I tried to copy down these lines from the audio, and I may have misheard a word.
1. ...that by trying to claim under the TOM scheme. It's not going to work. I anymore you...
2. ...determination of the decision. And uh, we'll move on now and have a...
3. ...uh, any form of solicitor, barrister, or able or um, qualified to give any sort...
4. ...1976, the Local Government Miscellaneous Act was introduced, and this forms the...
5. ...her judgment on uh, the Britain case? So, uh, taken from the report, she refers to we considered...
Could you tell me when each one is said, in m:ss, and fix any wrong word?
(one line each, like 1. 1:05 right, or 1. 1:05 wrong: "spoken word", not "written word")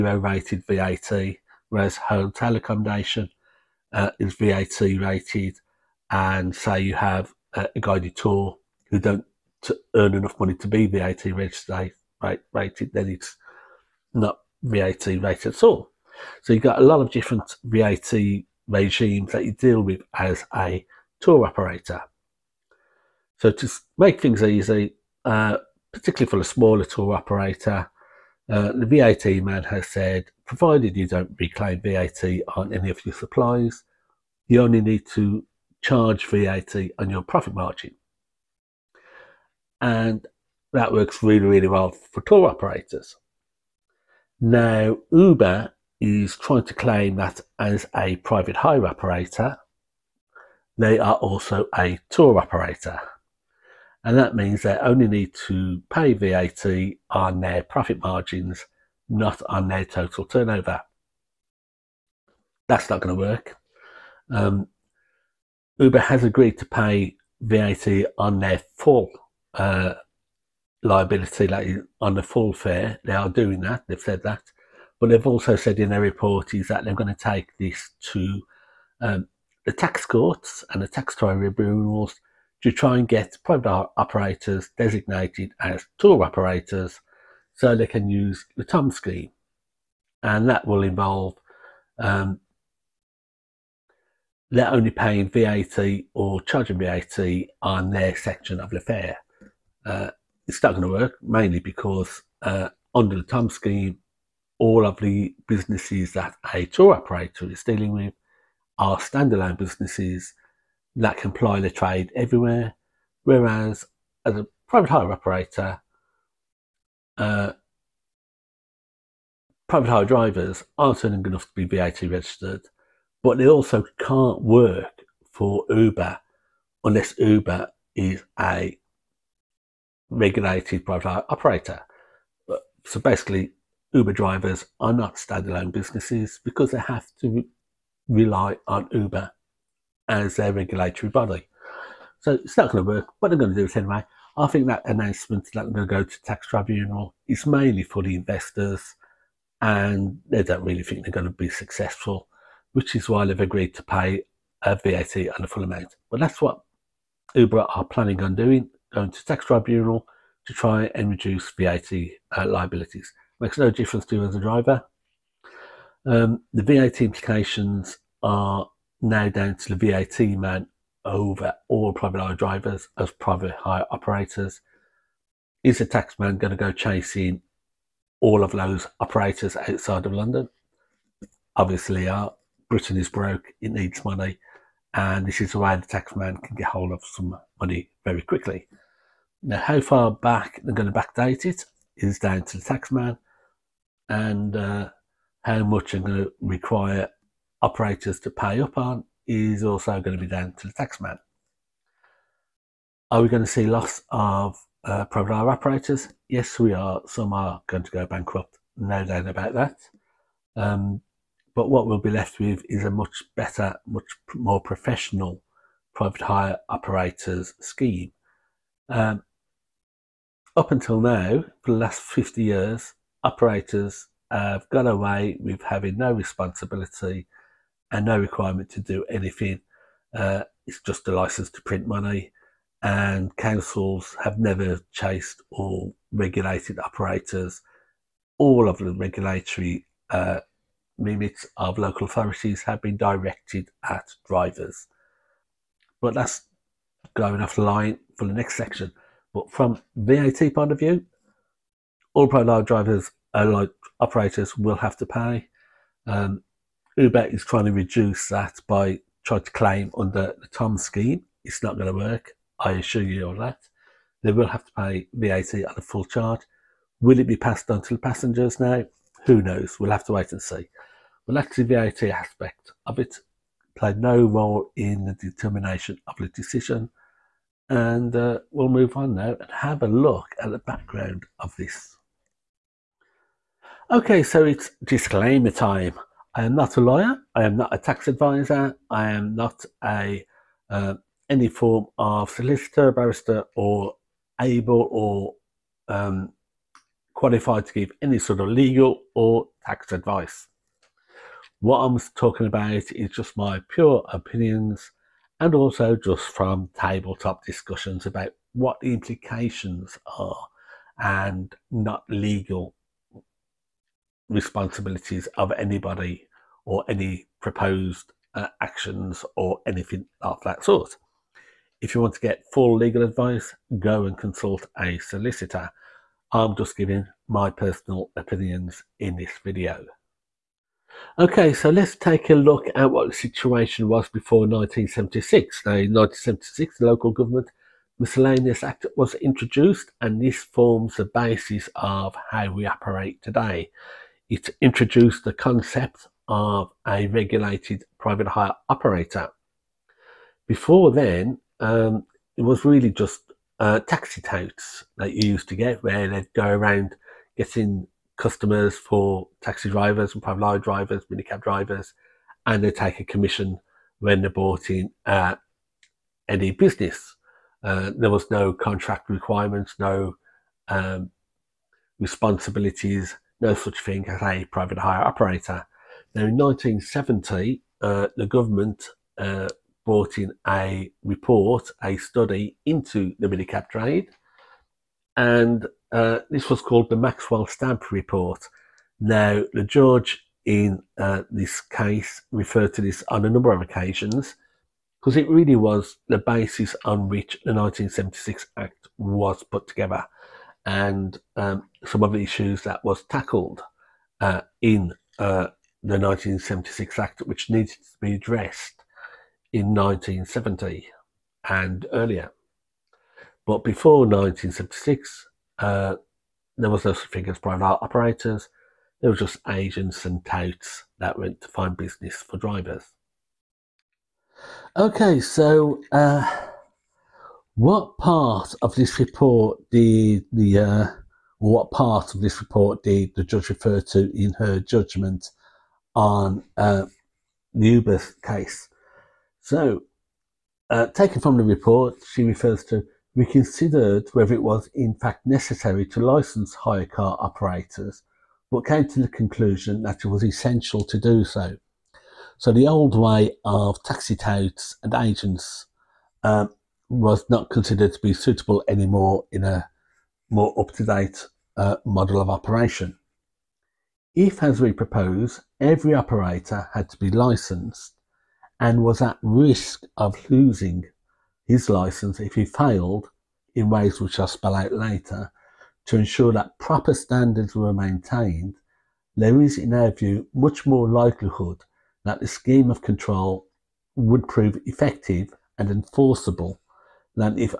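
1. 4:18 wrong: "assure", not "anymore"
2. 4:35 right
3. 4:50 right
4. 5:35 right
5. 7:14 wrong: "Ubers", not "Britain".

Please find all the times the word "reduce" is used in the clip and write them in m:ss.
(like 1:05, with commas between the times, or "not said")
2:41, 4:17.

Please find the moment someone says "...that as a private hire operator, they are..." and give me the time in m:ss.
0:47.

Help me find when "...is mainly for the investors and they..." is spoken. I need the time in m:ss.
2:27.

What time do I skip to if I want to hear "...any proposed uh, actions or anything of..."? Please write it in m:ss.
5:16.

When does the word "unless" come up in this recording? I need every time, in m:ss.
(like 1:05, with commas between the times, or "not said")
2:06.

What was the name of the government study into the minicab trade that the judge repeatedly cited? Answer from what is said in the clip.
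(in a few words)
Maxwell Stamp Report.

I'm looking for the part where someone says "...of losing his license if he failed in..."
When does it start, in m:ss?
7:49.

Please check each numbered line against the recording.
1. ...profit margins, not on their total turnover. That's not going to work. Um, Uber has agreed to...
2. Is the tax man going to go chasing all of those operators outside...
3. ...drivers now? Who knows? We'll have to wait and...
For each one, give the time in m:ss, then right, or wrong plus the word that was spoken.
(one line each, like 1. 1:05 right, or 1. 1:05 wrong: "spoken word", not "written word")
1. 0:57 right
2. 2:55 right
3. 4:28 wrong: "passengers", not "drivers".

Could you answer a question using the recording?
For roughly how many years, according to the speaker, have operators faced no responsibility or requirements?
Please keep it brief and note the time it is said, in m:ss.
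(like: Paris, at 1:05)
50, at 3:42.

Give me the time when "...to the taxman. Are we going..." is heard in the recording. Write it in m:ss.
3:20.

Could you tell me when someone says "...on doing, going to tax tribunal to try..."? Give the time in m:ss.
2:38.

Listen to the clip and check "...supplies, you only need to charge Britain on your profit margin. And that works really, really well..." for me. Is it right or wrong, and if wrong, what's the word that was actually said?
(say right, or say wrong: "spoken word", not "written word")
wrong: "VAT", not "Britain".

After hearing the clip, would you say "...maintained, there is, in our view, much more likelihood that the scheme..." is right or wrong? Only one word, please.
right.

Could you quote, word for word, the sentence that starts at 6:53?
But before 1976, uh, there was no such thing as private operators.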